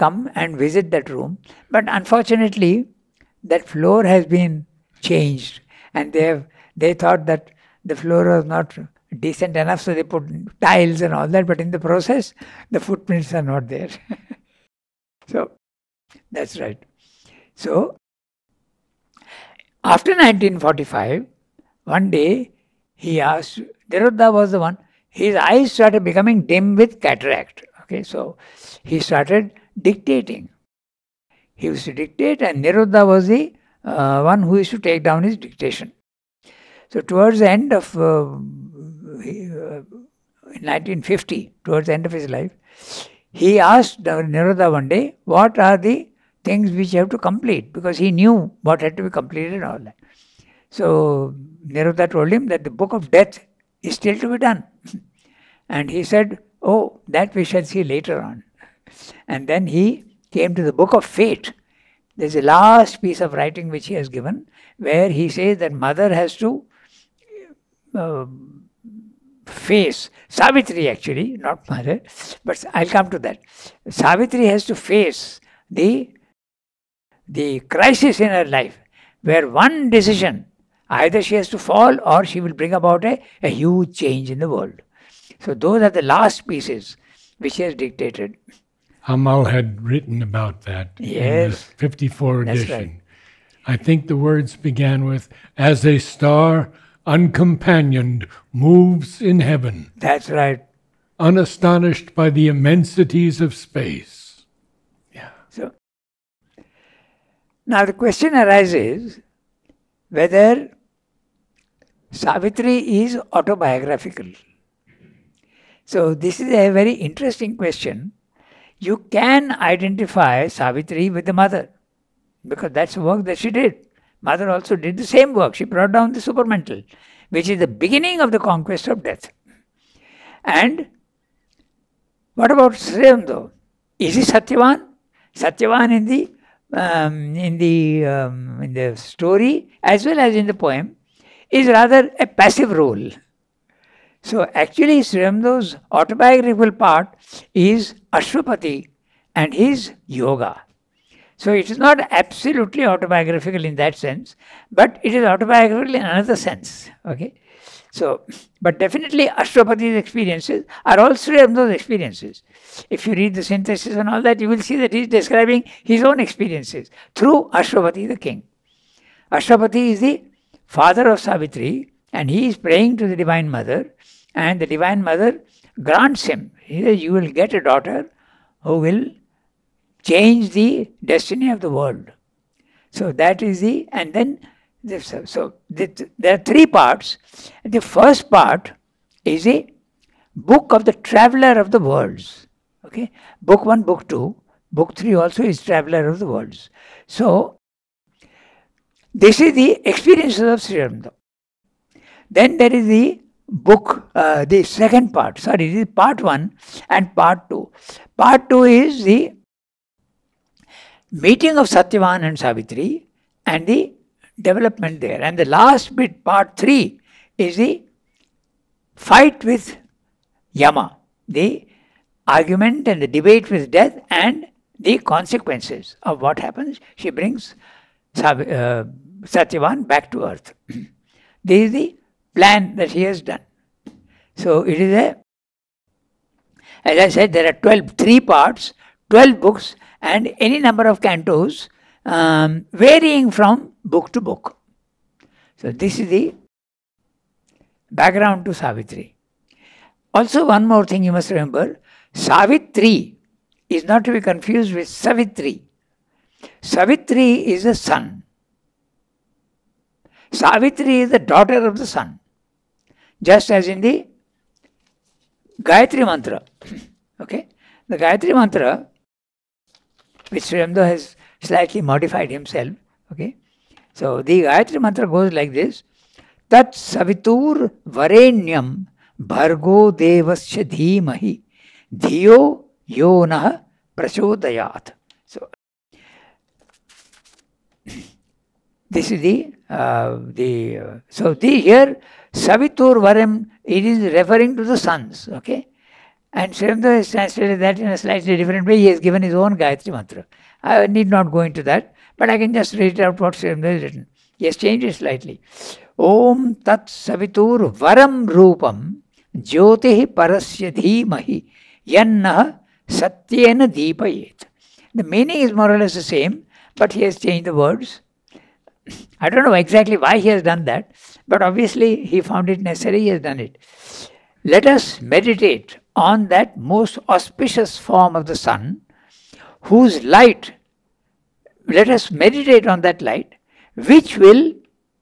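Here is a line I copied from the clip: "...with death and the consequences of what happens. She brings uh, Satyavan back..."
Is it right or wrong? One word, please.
right.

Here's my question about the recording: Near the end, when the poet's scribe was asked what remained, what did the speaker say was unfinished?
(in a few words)
The book of death.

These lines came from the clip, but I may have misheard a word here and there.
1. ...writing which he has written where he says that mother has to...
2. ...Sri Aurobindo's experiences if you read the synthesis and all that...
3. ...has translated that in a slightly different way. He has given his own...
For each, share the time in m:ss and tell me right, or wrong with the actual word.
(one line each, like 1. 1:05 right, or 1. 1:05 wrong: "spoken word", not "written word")
1. 1:03 wrong: "given", not "written"
2. 2:41 right
3. 4:56 right.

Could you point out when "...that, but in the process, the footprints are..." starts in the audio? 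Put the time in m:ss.
0:11.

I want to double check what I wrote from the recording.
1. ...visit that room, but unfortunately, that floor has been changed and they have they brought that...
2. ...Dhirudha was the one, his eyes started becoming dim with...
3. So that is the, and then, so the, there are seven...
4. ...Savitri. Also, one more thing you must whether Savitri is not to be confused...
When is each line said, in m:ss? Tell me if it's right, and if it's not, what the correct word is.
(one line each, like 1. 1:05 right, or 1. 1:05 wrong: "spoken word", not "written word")
1. 0:00 wrong: "thought", not "brought"
2. 0:23 right
3. 3:02 wrong: "three", not "seven"
4. 4:08 wrong: "remember", not "whether".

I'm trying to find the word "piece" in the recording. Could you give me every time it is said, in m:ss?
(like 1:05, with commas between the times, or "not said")
1:03, 1:26.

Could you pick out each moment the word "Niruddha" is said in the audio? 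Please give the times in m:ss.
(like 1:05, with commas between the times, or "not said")
0:32, 0:44.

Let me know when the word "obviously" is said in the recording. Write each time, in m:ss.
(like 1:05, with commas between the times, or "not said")
5:21.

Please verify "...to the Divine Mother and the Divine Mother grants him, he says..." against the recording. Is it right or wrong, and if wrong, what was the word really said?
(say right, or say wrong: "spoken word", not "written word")
right.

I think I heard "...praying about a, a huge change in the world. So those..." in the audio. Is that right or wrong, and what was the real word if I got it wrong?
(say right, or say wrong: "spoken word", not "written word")
wrong: "bring", not "praying".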